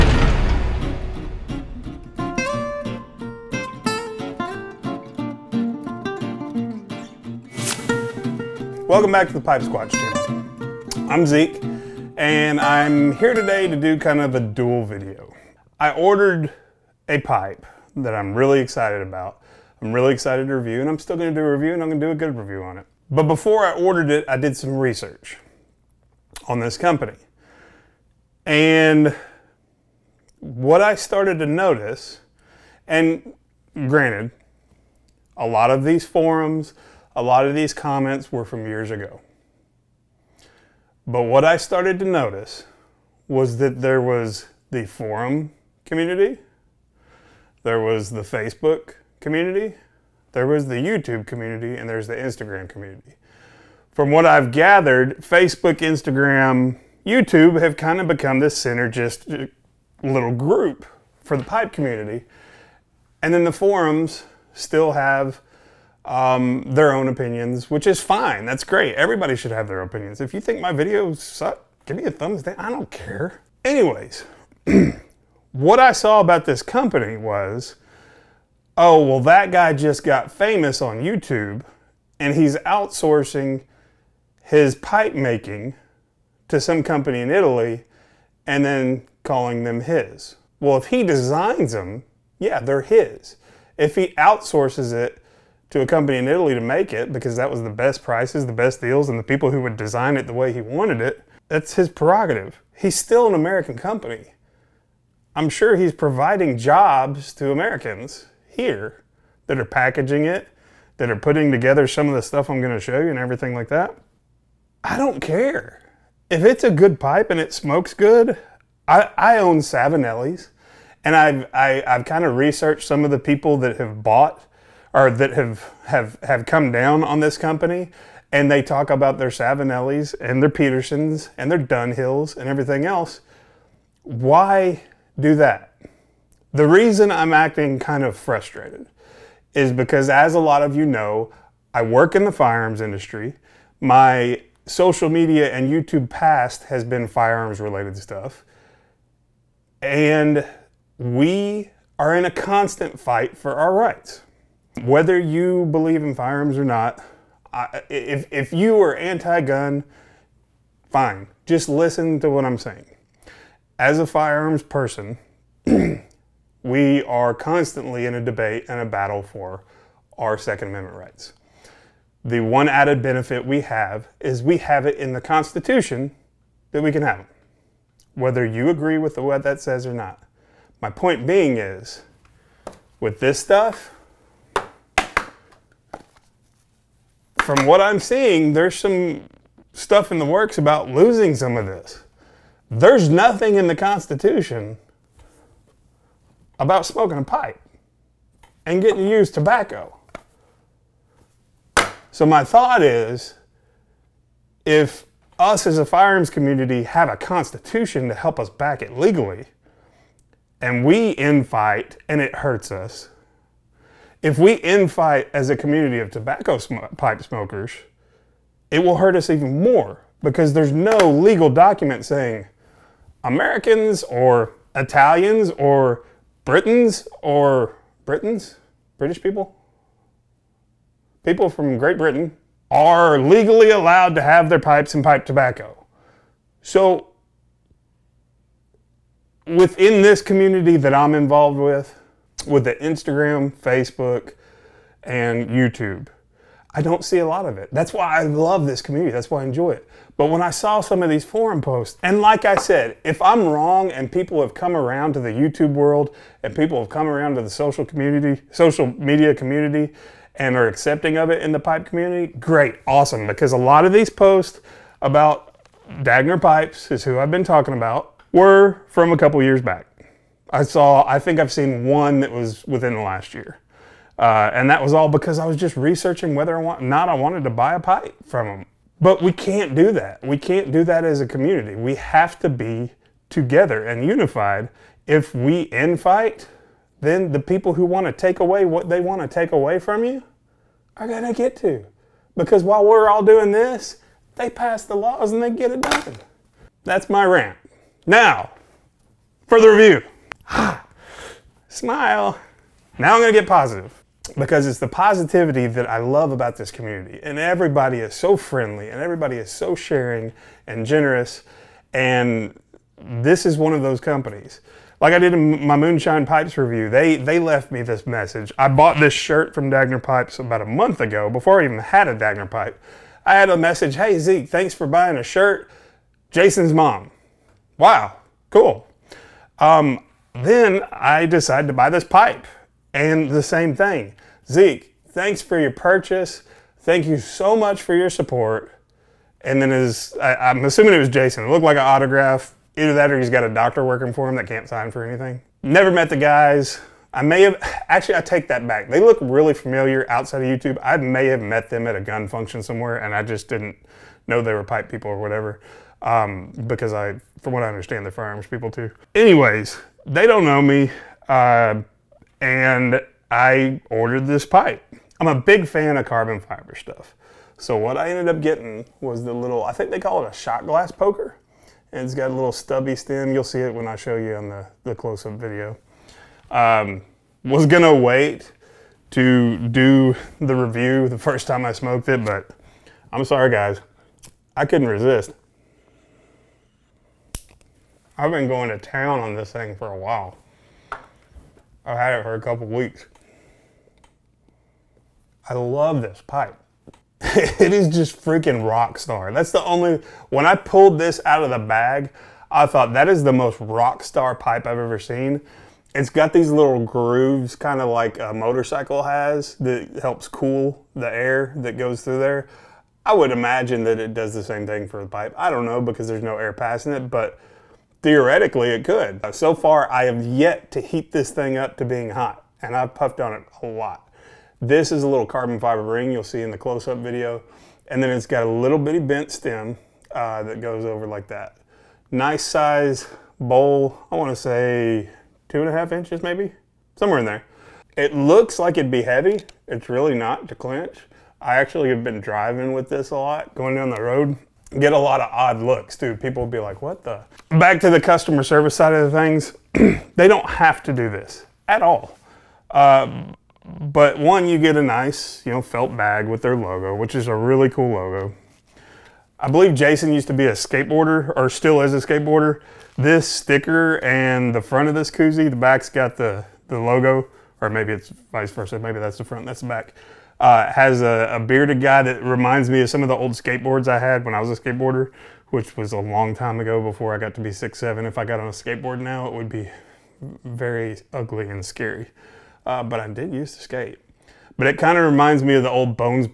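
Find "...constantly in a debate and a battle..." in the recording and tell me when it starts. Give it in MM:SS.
02:47.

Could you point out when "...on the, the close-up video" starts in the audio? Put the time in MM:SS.
06:14.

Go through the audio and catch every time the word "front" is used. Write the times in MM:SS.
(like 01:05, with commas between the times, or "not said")
07:44, 07:49.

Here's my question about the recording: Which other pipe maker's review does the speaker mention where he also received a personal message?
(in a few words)
Moonshine Pipes.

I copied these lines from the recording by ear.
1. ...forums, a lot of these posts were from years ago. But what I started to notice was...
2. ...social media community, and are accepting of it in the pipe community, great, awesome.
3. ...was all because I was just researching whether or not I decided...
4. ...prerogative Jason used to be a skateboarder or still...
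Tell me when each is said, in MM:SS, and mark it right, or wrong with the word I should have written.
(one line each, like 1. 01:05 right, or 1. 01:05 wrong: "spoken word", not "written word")
1. 00:36 wrong: "comments", not "posts"
2. 04:18 right
3. 04:34 wrong: "wanted", not "decided"
4. 07:39 wrong: "believe", not "prerogative".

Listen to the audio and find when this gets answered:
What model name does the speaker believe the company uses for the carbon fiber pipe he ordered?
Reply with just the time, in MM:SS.
06:10.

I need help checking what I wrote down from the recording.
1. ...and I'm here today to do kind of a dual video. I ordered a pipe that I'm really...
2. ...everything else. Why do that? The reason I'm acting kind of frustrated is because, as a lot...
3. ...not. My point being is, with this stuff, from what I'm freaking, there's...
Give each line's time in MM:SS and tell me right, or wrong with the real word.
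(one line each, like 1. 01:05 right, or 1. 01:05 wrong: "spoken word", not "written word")
1. 00:12 right
2. 02:12 right
3. 02:59 wrong: "seeing", not "freaking".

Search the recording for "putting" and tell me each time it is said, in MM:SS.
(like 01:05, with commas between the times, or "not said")
01:51.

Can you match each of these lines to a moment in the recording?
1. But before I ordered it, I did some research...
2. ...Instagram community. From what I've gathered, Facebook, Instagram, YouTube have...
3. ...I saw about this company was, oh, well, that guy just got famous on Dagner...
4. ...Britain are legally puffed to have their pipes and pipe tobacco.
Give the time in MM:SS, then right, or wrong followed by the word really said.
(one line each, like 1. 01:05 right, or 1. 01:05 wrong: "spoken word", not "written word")
1. 00:23 right
2. 00:52 right
3. 01:15 wrong: "YouTube", not "Dagner"
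4. 03:51 wrong: "allowed", not "puffed".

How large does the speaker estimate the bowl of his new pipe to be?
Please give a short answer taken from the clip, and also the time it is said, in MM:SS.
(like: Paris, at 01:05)
2.5 inches, at 07:15.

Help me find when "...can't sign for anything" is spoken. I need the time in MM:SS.
05:44.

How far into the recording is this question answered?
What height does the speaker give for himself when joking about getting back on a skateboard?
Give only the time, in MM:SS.
07:57.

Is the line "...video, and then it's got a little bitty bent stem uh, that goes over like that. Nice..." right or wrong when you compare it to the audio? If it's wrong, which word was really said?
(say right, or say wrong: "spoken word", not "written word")
right.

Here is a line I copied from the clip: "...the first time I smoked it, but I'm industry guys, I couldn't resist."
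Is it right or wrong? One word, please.
wrong.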